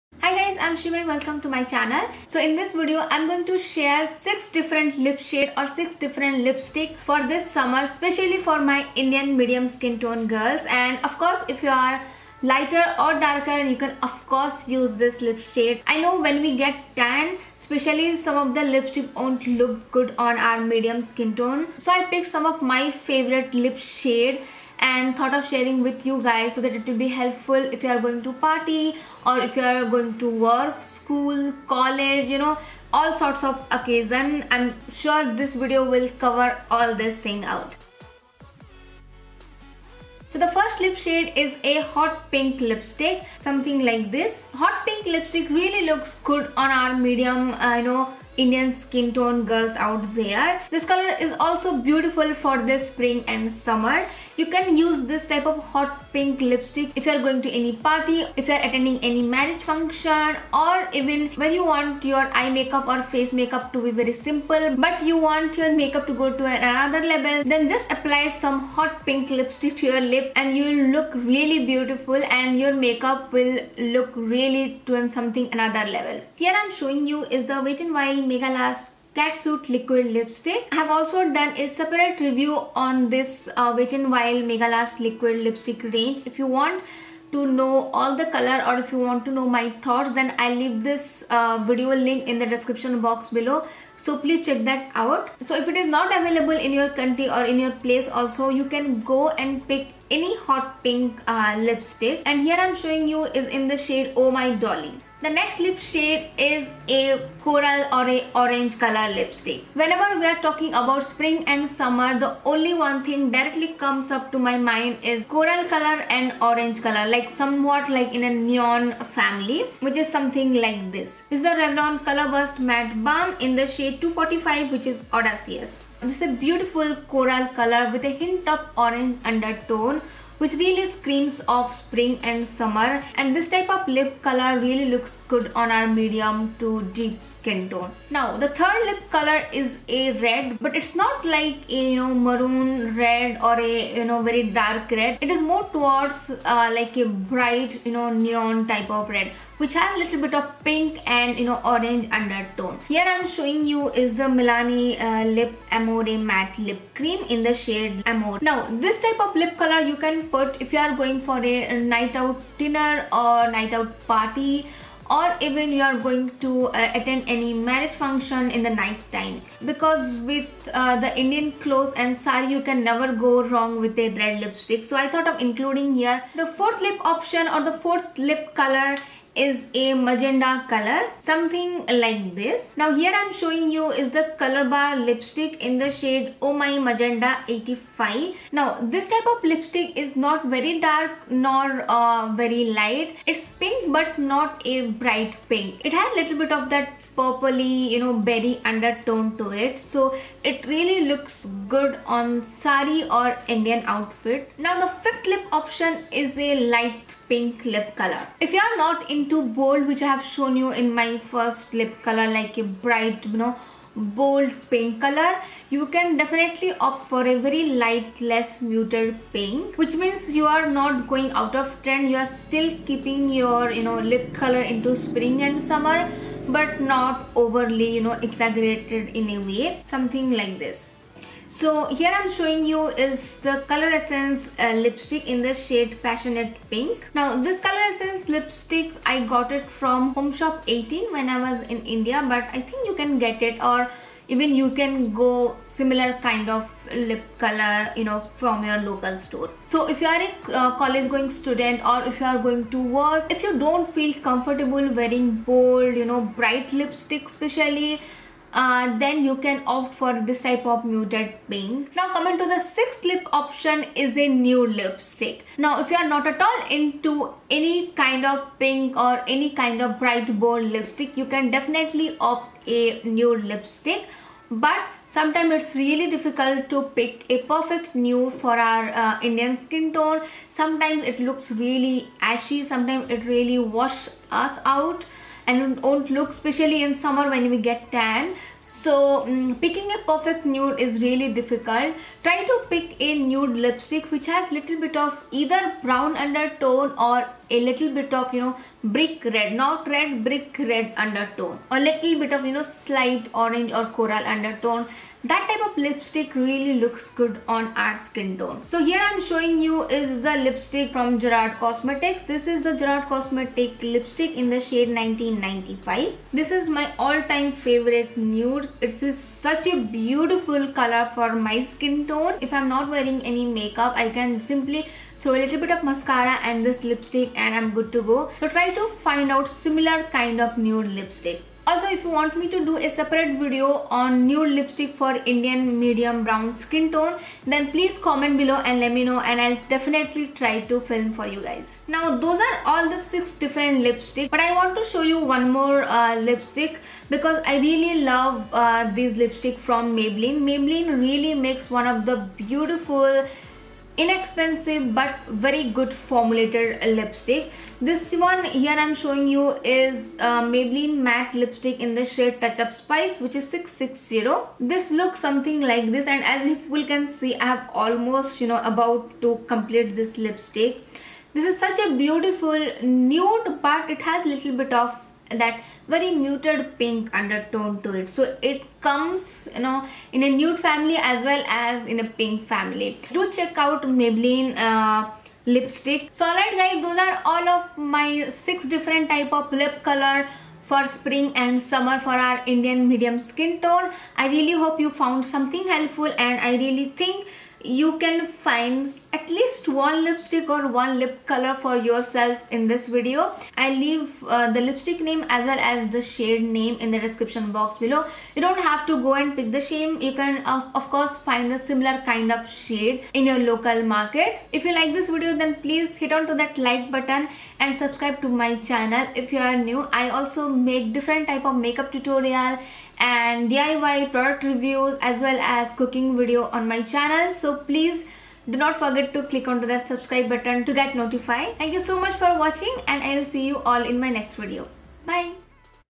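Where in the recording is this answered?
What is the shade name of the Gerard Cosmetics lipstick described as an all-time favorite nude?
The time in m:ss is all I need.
5:14.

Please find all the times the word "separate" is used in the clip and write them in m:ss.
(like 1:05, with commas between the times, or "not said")
1:21, 5:32.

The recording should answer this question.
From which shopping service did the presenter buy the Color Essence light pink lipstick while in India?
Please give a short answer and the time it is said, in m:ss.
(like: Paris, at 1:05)
Home Shop 18, at 4:00.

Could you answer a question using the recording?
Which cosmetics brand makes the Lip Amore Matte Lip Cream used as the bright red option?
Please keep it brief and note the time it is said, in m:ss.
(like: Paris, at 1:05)
Milani, at 2:34.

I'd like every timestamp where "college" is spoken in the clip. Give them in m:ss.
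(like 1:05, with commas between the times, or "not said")
0:31, 4:10.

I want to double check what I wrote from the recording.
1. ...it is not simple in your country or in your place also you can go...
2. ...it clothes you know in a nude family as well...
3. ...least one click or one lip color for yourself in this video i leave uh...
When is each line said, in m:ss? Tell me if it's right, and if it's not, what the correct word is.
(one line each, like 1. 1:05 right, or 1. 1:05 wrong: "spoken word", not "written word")
1. 1:35 wrong: "available", not "simple"
2. 6:18 wrong: "comes", not "clothes"
3. 6:39 wrong: "lipstick", not "click".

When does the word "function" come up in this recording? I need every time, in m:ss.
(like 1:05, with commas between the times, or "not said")
0:59, 2:48.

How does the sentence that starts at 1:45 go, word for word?
The next lip shade is a coral or a orange color lipstick.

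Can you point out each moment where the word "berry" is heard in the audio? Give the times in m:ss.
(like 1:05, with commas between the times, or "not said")
3:18.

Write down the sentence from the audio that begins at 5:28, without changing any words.
So try to find out similar kind of nude lipstick.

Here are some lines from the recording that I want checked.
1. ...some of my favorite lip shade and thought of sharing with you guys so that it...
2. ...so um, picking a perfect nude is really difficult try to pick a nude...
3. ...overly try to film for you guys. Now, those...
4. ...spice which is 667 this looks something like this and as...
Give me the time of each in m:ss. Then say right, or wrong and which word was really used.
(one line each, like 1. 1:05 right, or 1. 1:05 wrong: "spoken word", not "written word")
1. 0:22 right
2. 4:48 right
3. 5:39 wrong: "definitely", not "overly"
4. 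6:02 wrong: "660", not "667".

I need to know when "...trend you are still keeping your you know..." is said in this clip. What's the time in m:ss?
3:41.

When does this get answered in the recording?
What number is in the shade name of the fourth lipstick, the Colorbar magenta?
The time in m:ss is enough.
3:07.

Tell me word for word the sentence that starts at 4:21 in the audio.
Now coming to the sixth lip option is a new lipstick.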